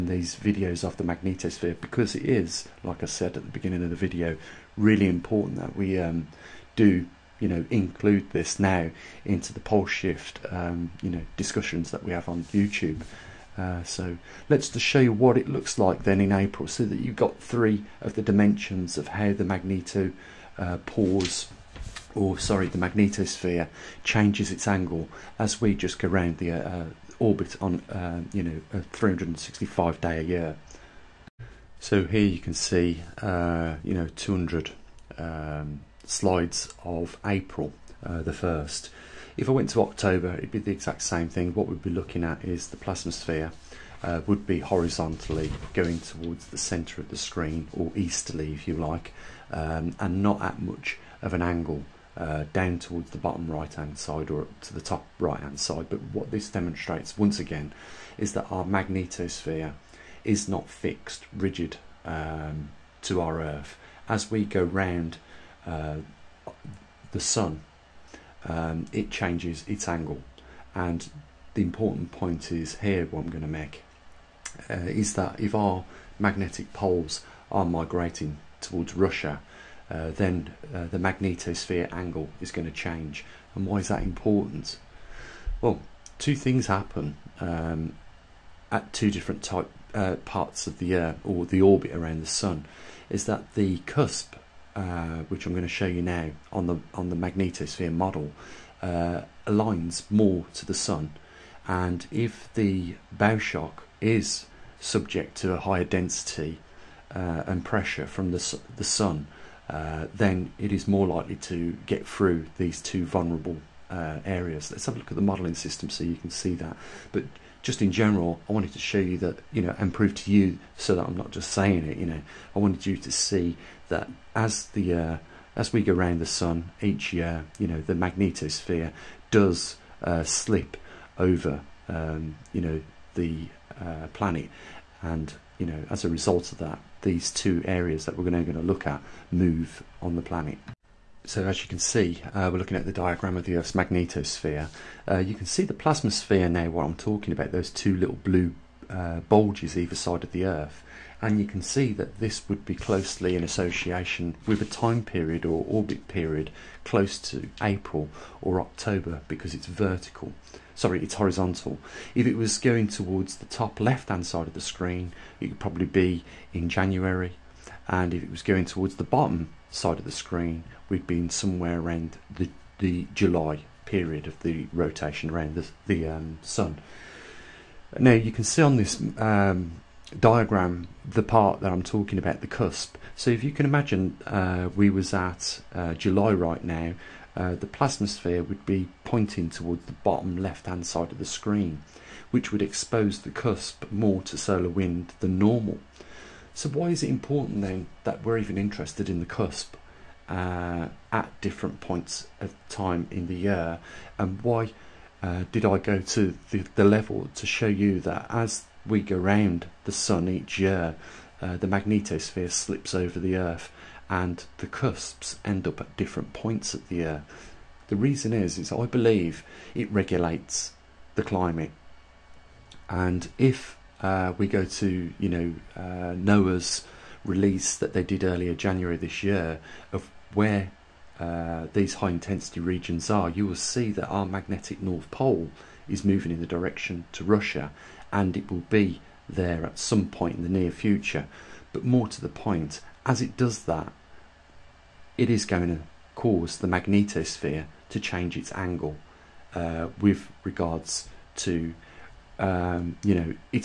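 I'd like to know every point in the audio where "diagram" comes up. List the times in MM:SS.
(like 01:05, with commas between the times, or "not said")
02:22, 03:00.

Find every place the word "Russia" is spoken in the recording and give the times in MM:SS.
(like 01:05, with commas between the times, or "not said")
01:18, 03:57.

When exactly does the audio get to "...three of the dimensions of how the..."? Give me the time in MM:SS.
00:17.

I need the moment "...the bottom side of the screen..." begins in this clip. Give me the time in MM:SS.
02:48.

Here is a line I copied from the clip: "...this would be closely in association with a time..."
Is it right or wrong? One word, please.
right.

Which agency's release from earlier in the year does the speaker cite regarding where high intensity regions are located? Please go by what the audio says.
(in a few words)
NOAA.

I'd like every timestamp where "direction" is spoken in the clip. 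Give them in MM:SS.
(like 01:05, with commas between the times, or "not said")
03:56.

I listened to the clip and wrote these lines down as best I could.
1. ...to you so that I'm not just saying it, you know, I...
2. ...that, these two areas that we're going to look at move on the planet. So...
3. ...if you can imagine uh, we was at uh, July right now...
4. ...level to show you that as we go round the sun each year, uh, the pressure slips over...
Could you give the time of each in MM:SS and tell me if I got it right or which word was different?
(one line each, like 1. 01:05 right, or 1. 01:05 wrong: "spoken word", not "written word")
1. 02:00 right
2. 02:16 right
3. 03:03 right
4. 03:26 wrong: "magnetosphere", not "pressure".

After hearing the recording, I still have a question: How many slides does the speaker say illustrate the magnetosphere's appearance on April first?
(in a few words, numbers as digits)
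200.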